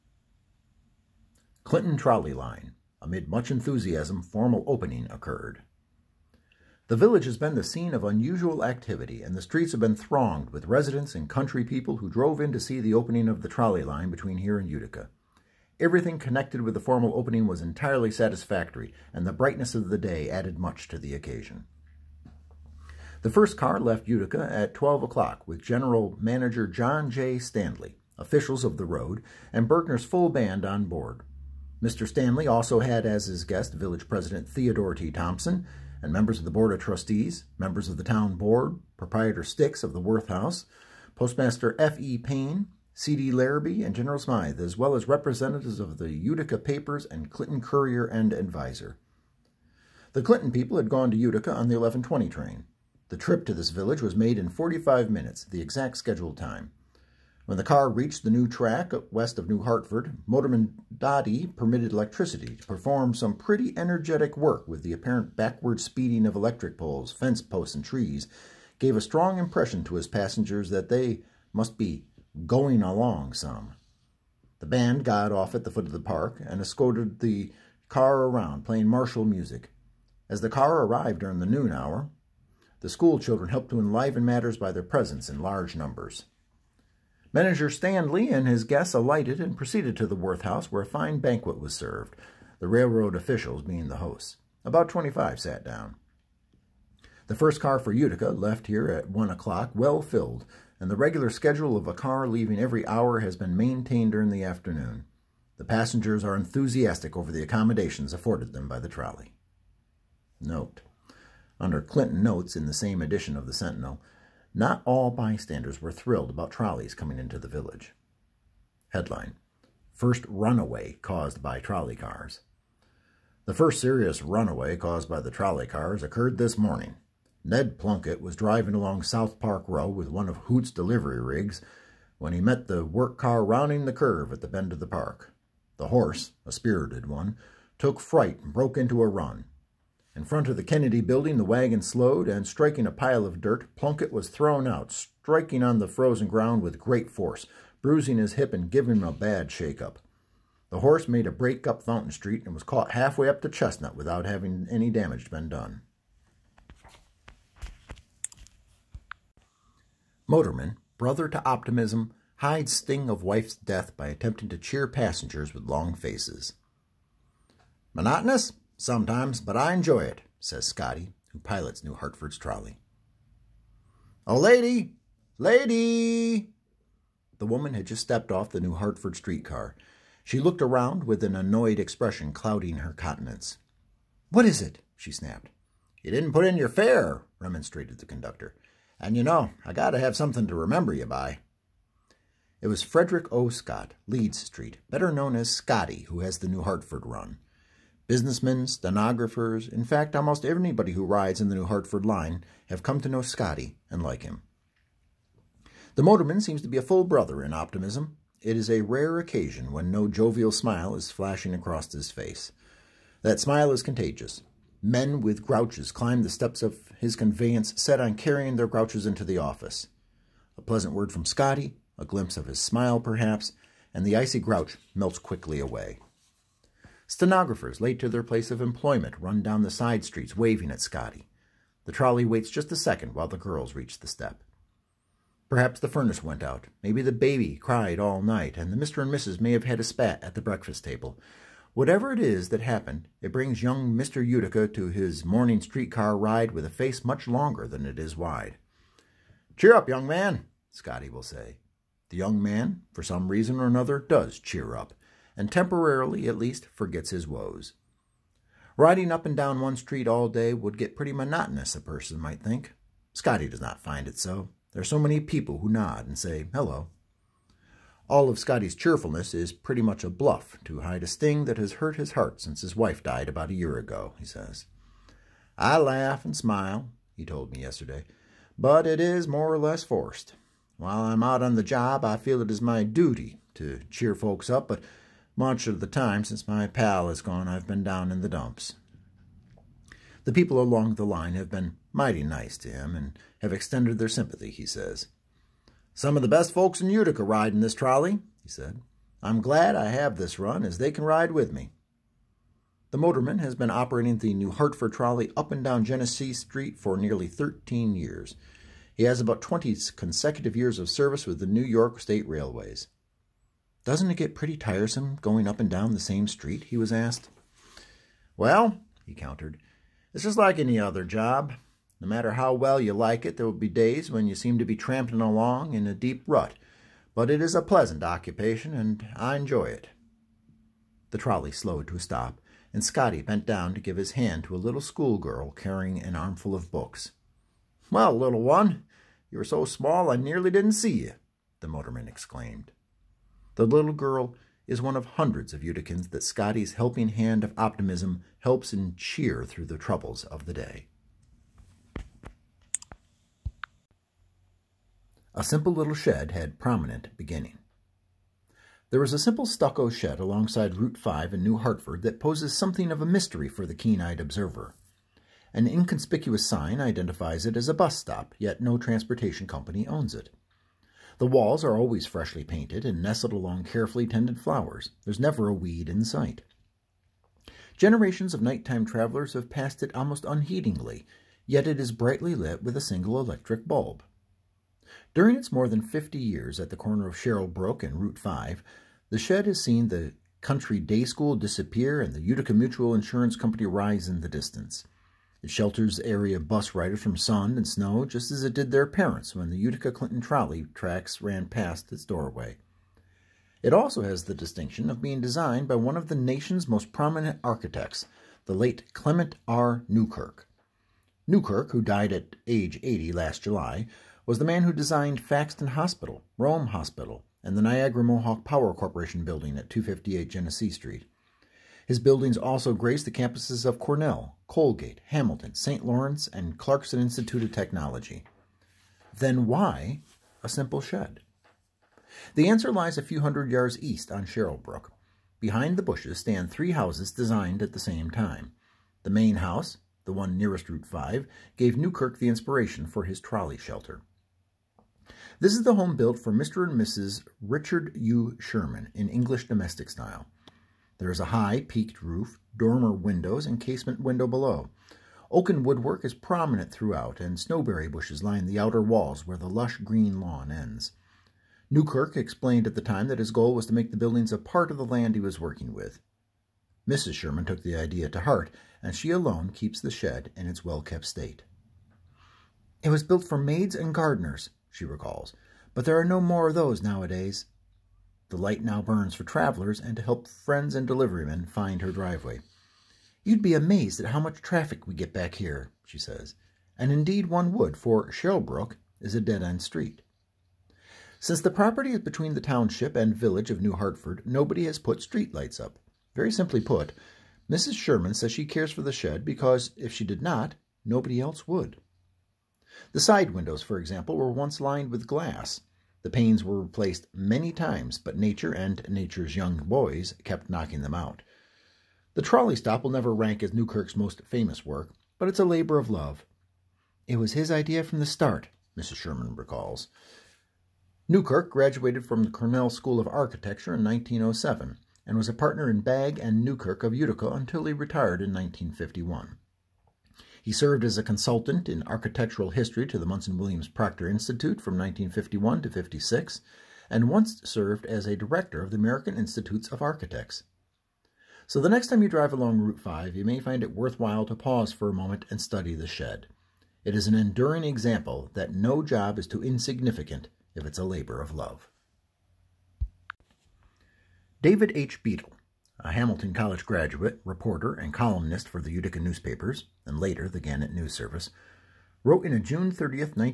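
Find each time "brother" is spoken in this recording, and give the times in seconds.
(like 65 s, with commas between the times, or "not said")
160 s, 207 s.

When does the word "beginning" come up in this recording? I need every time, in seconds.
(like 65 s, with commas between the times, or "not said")
357 s.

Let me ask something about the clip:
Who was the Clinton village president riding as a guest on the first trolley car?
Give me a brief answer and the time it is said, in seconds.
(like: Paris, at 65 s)
Theodore T. Thompson, at 34 s.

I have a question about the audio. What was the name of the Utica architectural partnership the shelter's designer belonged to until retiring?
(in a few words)
Bagg and Newkirk.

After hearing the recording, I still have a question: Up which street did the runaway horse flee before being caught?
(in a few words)
Fountain Street.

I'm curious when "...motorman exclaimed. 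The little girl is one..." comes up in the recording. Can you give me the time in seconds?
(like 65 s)
341 s.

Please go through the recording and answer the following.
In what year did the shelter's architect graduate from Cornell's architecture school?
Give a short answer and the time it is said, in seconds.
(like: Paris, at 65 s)
1907, at 523 s.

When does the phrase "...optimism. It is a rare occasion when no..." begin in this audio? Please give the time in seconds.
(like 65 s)
207 s.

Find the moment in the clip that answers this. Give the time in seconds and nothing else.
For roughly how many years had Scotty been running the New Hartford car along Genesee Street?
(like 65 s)
307 s.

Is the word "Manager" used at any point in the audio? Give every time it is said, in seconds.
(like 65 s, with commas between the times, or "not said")
26 s, 87 s.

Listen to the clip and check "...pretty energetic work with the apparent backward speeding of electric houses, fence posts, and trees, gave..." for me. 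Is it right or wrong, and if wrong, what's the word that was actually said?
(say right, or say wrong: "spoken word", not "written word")
wrong: "poles", not "houses".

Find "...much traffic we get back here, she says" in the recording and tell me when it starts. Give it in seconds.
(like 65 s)
484 s.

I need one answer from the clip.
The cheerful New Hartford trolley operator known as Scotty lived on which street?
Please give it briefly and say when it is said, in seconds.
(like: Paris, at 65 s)
Leeds Street, at 194 s.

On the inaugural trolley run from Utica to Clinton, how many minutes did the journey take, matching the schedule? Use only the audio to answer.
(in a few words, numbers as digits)
45.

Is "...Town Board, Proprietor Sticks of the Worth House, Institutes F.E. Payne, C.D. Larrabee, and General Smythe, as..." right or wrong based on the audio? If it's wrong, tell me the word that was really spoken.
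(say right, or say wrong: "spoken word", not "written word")
wrong: "Postmaster", not "Institutes".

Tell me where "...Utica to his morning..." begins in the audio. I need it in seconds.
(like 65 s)
244 s.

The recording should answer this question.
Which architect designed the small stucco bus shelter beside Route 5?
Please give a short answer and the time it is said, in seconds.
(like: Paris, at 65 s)
Clement R. Newkirk, at 408 s.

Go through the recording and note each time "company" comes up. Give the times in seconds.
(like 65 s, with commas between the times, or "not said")
369 s, 393 s.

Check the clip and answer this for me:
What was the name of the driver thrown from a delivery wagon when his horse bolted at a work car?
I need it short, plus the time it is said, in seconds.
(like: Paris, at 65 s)
Ned Plunkett, at 127 s.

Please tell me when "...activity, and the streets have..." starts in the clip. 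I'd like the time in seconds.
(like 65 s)
8 s.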